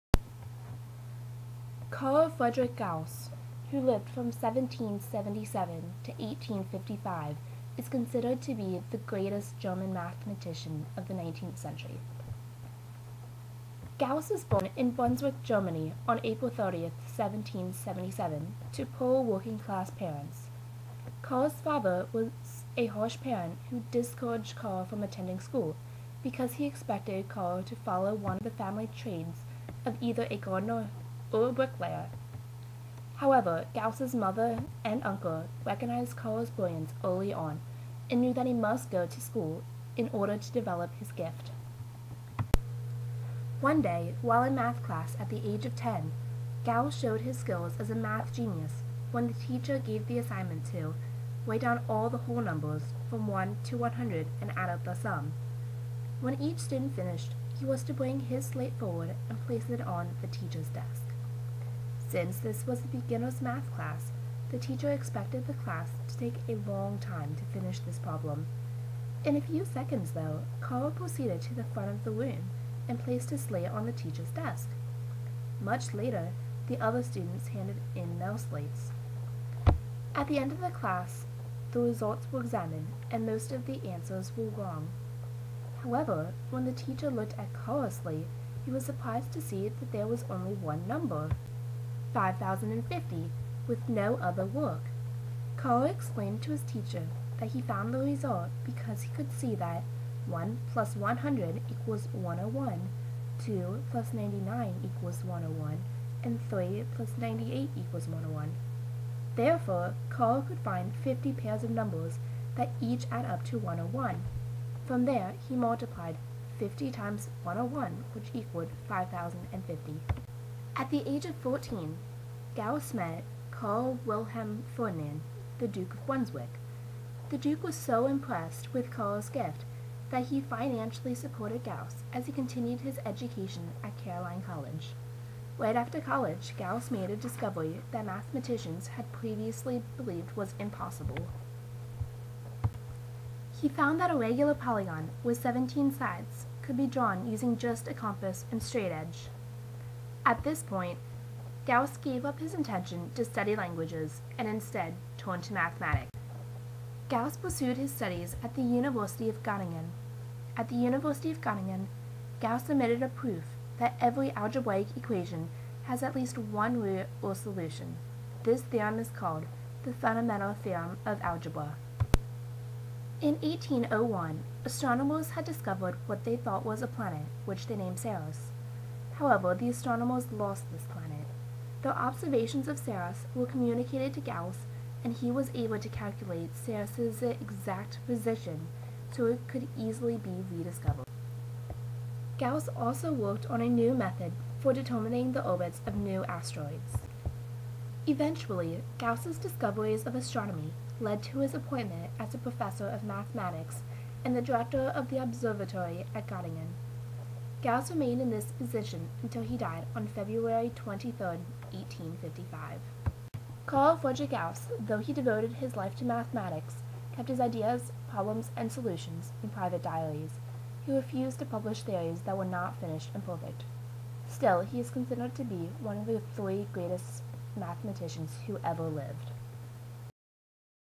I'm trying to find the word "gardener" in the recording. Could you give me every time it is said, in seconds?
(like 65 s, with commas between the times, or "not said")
30 s.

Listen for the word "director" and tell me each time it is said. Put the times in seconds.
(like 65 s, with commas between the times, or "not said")
204 s.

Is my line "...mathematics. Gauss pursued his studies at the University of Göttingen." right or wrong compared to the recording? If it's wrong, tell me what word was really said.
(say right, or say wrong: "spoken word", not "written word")
right.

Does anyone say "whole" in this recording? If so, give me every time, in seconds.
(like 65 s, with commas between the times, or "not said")
52 s.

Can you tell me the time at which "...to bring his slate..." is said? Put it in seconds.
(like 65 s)
57 s.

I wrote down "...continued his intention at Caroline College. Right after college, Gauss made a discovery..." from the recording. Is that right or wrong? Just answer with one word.
wrong.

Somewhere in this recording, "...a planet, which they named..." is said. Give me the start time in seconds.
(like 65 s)
176 s.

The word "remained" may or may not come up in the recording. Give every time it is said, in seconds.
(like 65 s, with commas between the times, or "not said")
207 s.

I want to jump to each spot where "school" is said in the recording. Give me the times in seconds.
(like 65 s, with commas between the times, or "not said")
25 s, 39 s.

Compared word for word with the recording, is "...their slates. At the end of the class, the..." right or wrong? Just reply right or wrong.
right.